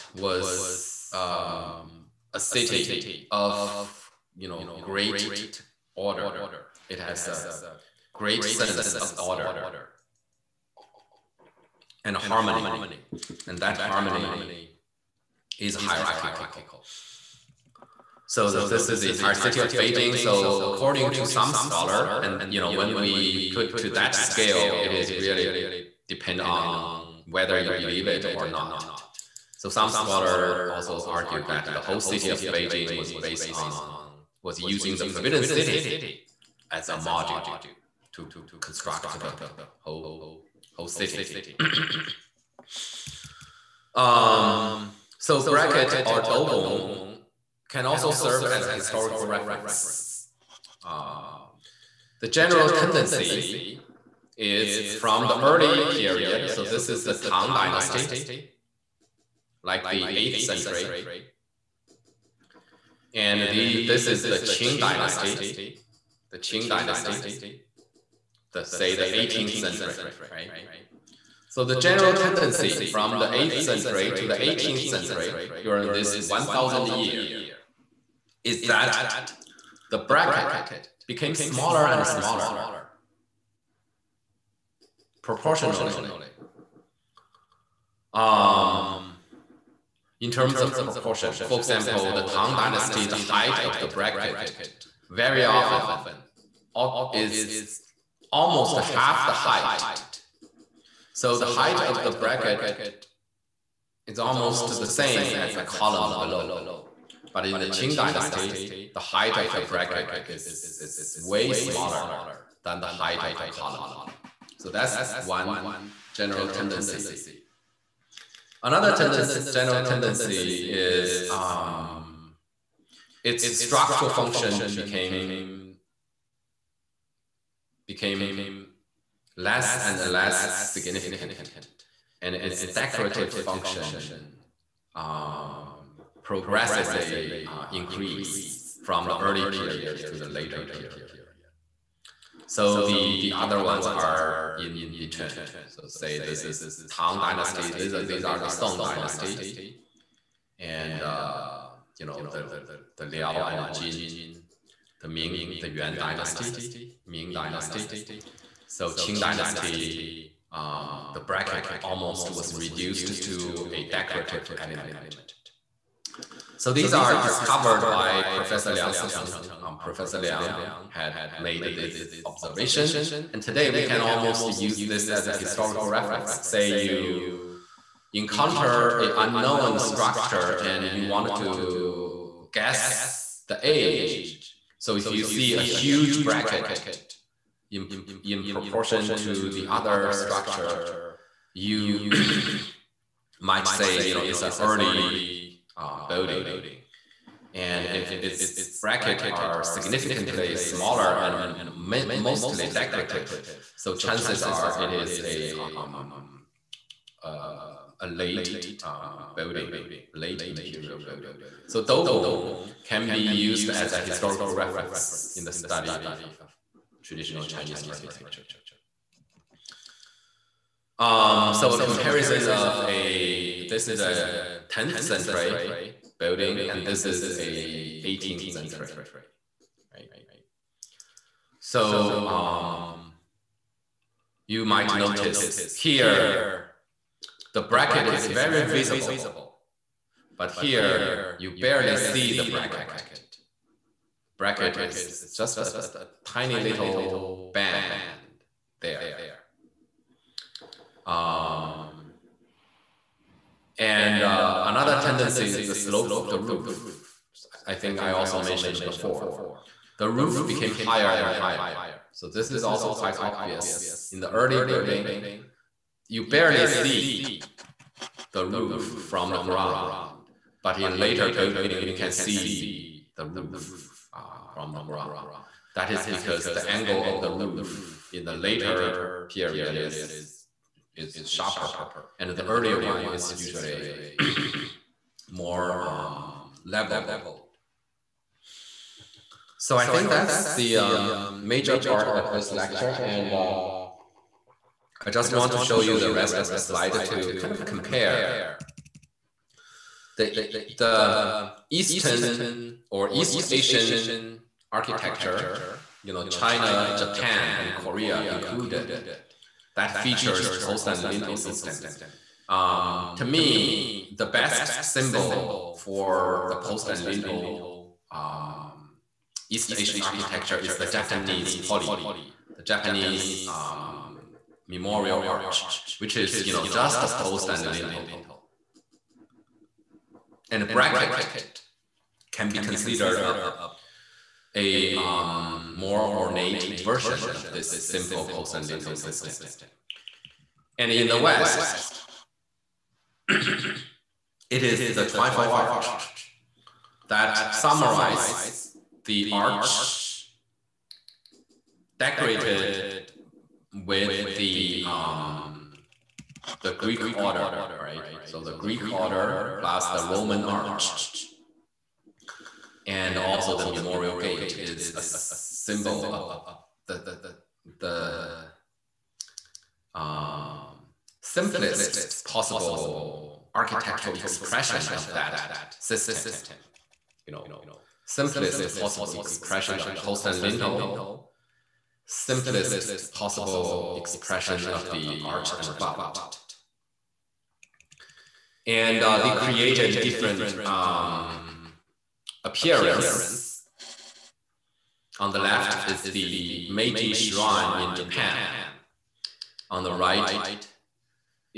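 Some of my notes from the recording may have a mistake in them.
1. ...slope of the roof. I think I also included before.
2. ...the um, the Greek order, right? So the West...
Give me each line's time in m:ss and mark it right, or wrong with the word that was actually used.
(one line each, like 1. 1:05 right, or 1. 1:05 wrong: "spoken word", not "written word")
1. 4:15 wrong: "mentioned", not "included"
2. 5:54 wrong: "Greek", not "West".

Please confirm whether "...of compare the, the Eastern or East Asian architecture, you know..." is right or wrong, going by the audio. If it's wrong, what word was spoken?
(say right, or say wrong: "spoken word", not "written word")
right.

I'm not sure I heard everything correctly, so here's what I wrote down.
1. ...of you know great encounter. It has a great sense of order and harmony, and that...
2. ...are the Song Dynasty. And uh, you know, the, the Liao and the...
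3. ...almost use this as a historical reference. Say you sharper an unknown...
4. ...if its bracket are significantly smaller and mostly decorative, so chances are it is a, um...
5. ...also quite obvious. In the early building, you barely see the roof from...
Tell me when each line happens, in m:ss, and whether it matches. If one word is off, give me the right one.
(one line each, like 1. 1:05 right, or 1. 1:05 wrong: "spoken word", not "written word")
1. 0:03 wrong: "order", not "encounter"
2. 2:28 right
3. 2:54 wrong: "encounter", not "sharper"
4. 3:17 right
5. 4:22 right.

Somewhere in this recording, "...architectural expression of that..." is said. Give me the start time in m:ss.
6:13.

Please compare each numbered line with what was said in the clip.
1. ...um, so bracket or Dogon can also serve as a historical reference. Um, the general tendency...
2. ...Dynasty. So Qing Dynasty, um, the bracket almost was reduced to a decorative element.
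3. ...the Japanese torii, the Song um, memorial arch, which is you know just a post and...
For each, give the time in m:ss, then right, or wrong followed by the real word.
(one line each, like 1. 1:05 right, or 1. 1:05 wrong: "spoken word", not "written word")
1. 0:43 right
2. 2:37 right
3. 5:20 wrong: "Japanese", not "Song".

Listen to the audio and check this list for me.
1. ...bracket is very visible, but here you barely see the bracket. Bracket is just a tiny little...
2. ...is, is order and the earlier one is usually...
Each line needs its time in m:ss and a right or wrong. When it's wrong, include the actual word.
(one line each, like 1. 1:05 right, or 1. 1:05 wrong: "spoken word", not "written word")
1. 3:57 right
2. 4:39 wrong: "sharper", not "order".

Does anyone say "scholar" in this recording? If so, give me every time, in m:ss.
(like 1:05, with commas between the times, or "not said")
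0:21, 0:29.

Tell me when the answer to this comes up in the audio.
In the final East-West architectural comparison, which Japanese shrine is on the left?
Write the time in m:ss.
6:36.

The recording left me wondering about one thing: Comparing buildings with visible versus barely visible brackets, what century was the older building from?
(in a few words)
10th century.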